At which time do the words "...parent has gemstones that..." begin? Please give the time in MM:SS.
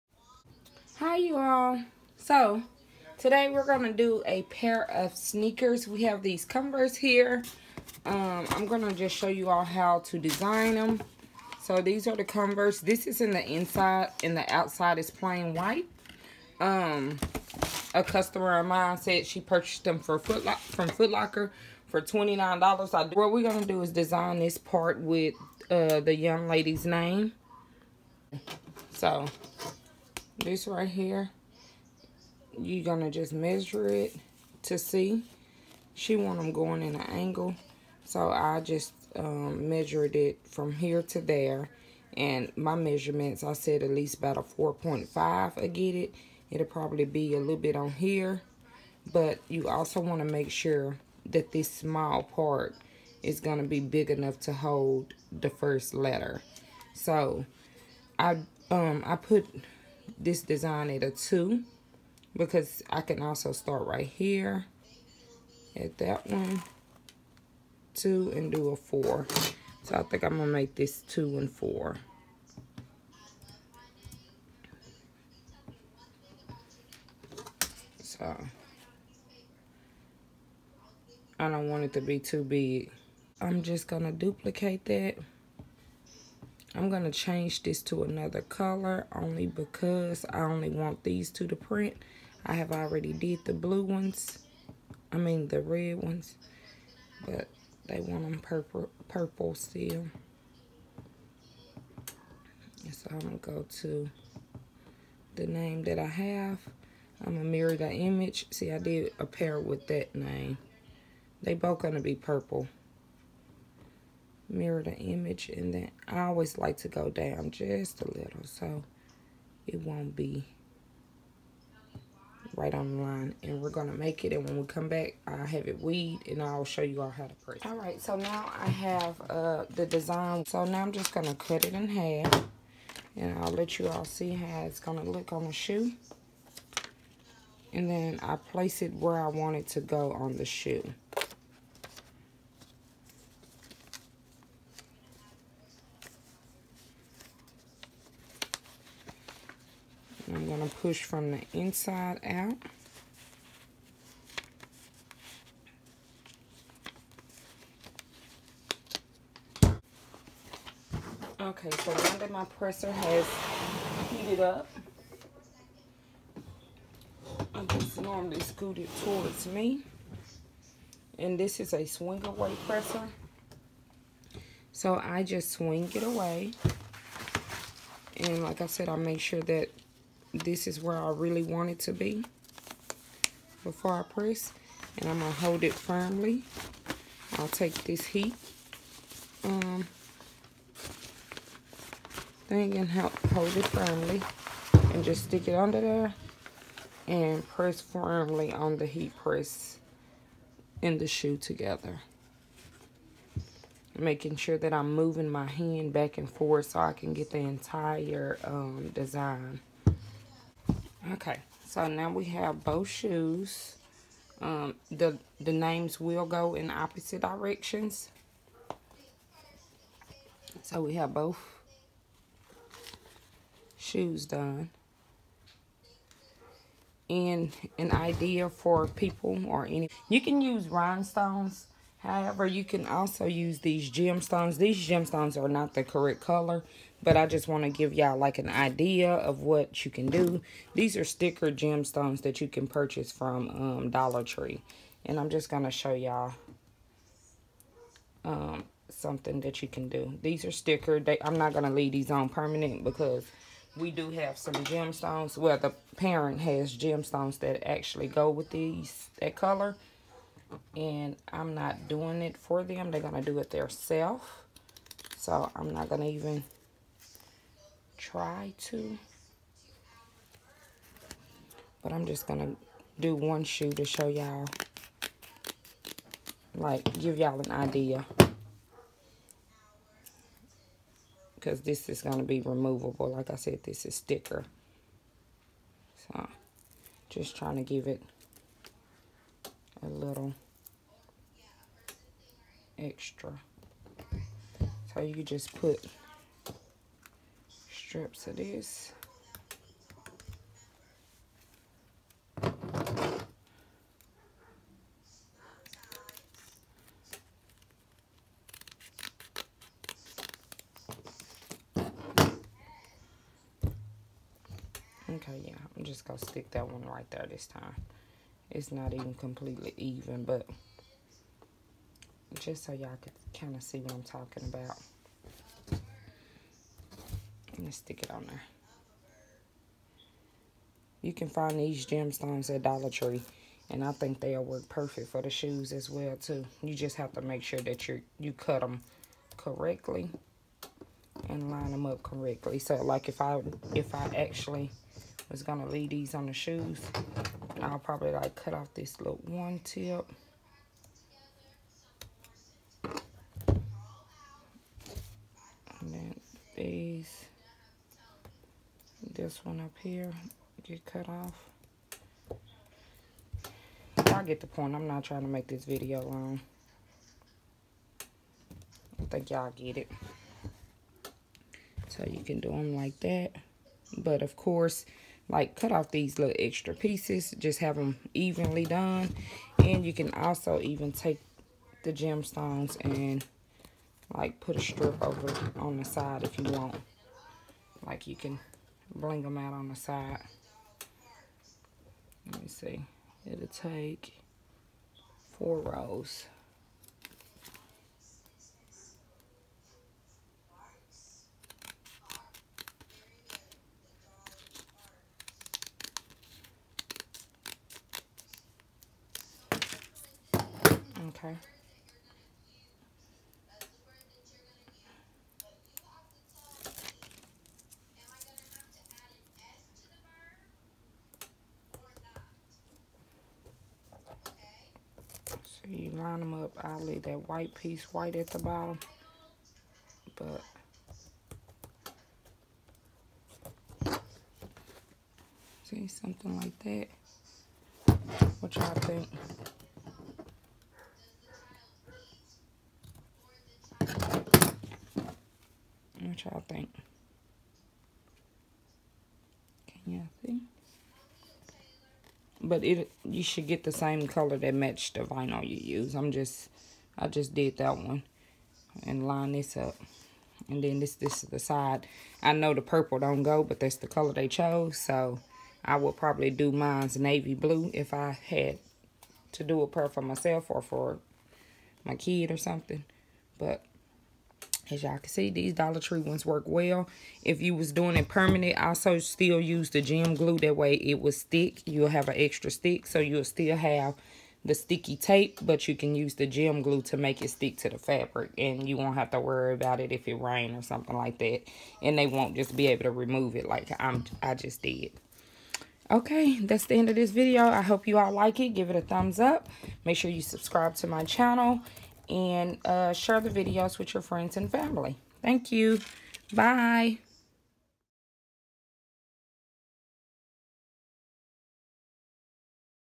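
04:15.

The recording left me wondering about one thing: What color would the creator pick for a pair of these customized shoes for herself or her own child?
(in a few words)
navy blue.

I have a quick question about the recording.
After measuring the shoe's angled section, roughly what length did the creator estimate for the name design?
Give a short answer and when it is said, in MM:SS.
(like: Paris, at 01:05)
4.5, at 00:44.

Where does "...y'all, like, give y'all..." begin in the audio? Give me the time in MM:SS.
04:34.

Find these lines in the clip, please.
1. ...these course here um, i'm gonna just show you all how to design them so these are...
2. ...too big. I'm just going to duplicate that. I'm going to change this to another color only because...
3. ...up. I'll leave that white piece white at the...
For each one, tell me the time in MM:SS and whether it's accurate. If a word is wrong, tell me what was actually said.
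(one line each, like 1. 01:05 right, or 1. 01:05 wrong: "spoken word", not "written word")
1. 00:06 wrong: "converse", not "course"
2. 01:22 right
3. 07:06 right.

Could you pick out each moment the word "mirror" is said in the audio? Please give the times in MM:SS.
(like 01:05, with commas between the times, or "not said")
01:47, 01:54.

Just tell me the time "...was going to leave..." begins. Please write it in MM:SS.
05:45.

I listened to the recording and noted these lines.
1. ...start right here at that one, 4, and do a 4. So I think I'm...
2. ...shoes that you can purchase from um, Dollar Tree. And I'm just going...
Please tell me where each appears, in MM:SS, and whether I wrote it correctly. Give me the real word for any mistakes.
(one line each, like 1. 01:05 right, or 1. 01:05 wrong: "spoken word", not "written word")
1. 01:03 wrong: "2", not "4"
2. 04:01 wrong: "gemstones", not "shoes".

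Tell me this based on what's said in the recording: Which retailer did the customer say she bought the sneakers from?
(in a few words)
Foot Locker.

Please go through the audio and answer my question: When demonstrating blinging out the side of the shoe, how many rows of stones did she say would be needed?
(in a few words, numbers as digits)
4.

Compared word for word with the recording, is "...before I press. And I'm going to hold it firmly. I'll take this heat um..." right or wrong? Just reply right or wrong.
right.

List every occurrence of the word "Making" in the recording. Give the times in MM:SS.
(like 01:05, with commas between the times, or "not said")
03:23.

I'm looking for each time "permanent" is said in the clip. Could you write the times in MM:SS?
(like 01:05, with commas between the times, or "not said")
04:12, 07:58.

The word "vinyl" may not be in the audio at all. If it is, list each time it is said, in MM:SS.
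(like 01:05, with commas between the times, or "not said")
07:35.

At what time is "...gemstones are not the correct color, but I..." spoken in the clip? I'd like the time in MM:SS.
03:54.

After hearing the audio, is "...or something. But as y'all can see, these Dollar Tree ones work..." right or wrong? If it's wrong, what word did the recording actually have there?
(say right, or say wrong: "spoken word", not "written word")
right.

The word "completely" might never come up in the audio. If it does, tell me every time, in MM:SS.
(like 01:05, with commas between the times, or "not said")
05:19.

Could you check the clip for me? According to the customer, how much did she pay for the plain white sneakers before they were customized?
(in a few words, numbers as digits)
$29.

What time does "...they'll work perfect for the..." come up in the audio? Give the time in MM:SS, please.
05:34.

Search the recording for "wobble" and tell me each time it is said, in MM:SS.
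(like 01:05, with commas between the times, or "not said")
not said.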